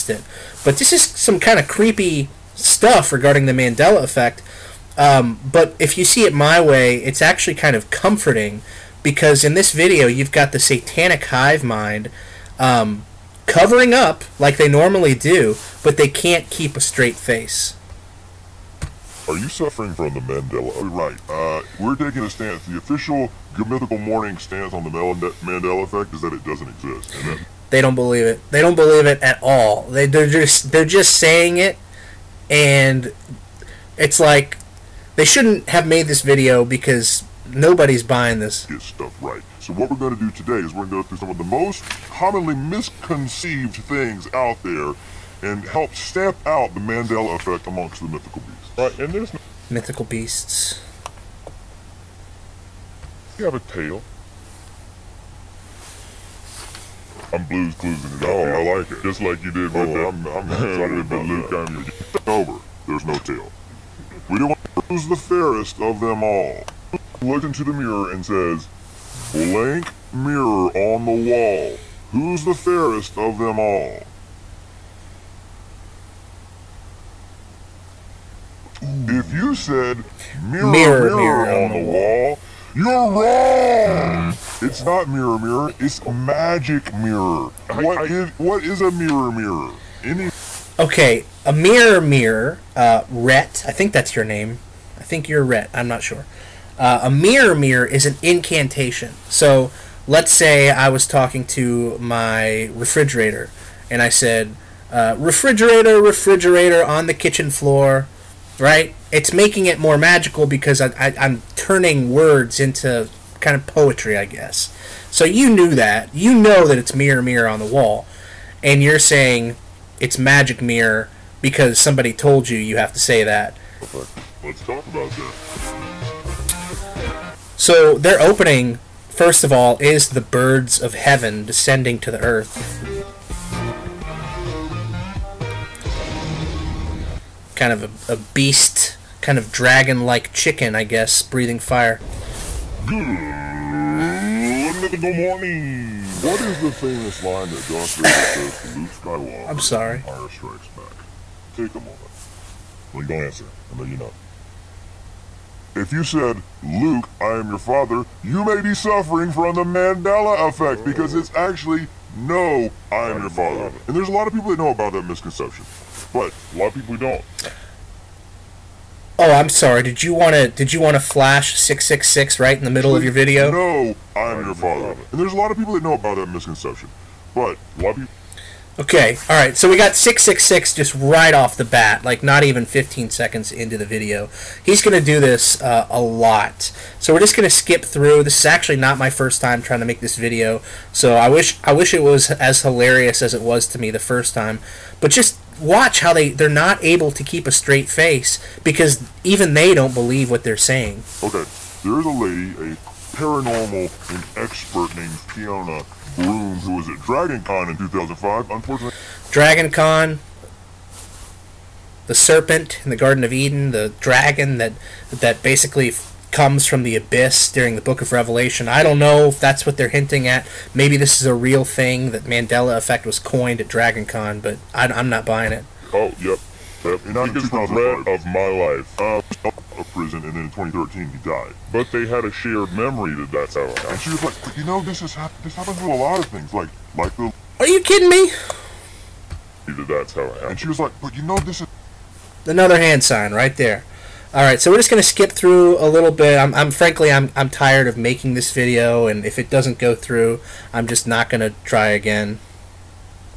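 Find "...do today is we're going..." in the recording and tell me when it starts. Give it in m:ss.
0:40.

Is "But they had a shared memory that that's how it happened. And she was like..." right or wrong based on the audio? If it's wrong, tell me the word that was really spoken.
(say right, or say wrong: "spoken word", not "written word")
right.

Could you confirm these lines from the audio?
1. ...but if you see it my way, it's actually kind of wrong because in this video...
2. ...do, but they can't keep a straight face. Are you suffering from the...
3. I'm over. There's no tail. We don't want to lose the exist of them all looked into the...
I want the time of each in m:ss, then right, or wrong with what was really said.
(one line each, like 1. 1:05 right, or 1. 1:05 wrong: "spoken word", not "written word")
1. 0:05 wrong: "comforting", not "wrong"
2. 0:15 right
3. 1:01 wrong: "fairest", not "exist".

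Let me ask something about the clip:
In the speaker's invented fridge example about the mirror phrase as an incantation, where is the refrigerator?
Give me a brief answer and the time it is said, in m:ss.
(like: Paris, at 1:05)
on the kitchen floor, at 1:46.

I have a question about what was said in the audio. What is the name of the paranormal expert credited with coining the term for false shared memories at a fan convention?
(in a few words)
Fiona Rooms.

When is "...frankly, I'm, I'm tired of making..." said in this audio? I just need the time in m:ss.
4:06.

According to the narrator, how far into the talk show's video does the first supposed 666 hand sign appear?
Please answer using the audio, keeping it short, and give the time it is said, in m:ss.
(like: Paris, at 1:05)
not even 15 seconds, at 3:02.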